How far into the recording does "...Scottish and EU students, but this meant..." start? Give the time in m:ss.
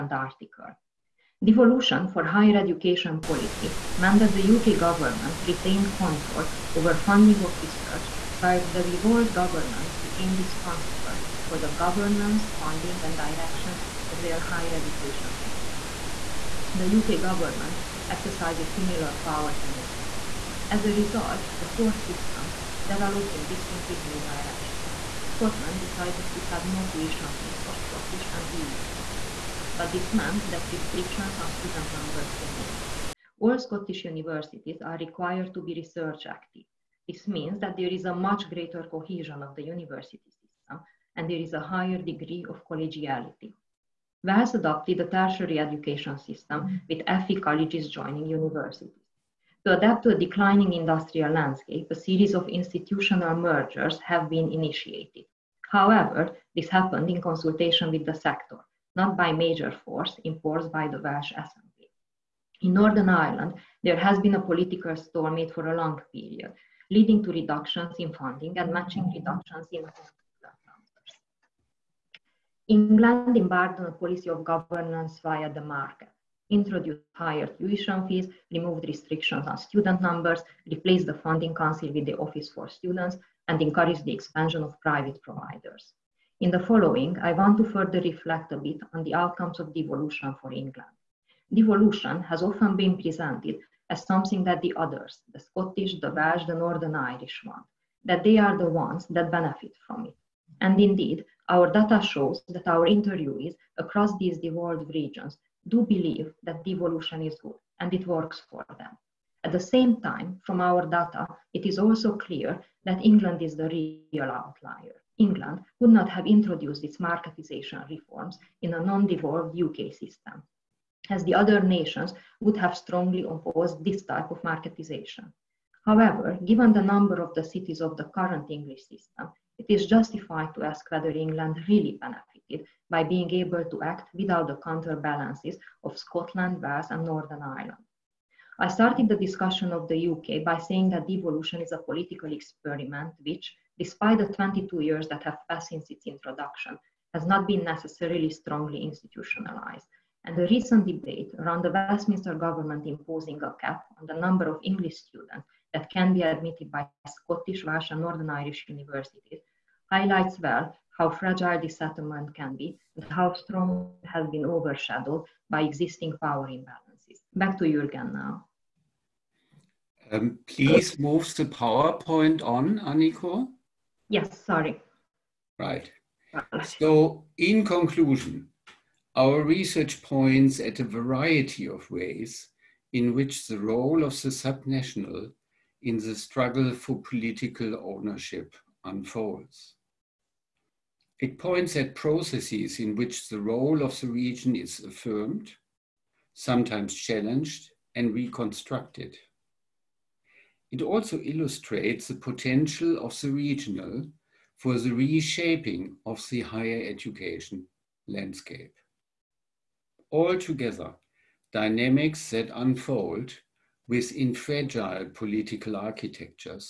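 0:27.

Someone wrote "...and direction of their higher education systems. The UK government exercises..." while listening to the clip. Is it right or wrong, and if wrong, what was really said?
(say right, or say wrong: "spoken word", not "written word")
right.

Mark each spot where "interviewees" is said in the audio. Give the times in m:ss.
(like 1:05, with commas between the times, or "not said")
1:42.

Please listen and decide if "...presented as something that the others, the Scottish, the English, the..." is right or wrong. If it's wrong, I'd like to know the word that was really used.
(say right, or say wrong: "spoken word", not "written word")
wrong: "Welsh", not "English".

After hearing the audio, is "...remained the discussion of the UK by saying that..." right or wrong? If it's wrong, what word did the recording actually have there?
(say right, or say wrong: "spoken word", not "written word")
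wrong: "started", not "remained".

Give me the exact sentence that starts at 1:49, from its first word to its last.
At the same time, from our data, it is also clear that England is the real outlier.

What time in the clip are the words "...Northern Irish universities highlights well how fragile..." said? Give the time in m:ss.
2:38.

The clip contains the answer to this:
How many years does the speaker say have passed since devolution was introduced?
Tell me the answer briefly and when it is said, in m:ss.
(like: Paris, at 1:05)
22, at 2:24.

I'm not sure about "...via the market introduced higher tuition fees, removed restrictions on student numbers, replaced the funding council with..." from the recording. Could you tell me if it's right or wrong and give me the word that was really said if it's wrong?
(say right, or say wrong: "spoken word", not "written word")
right.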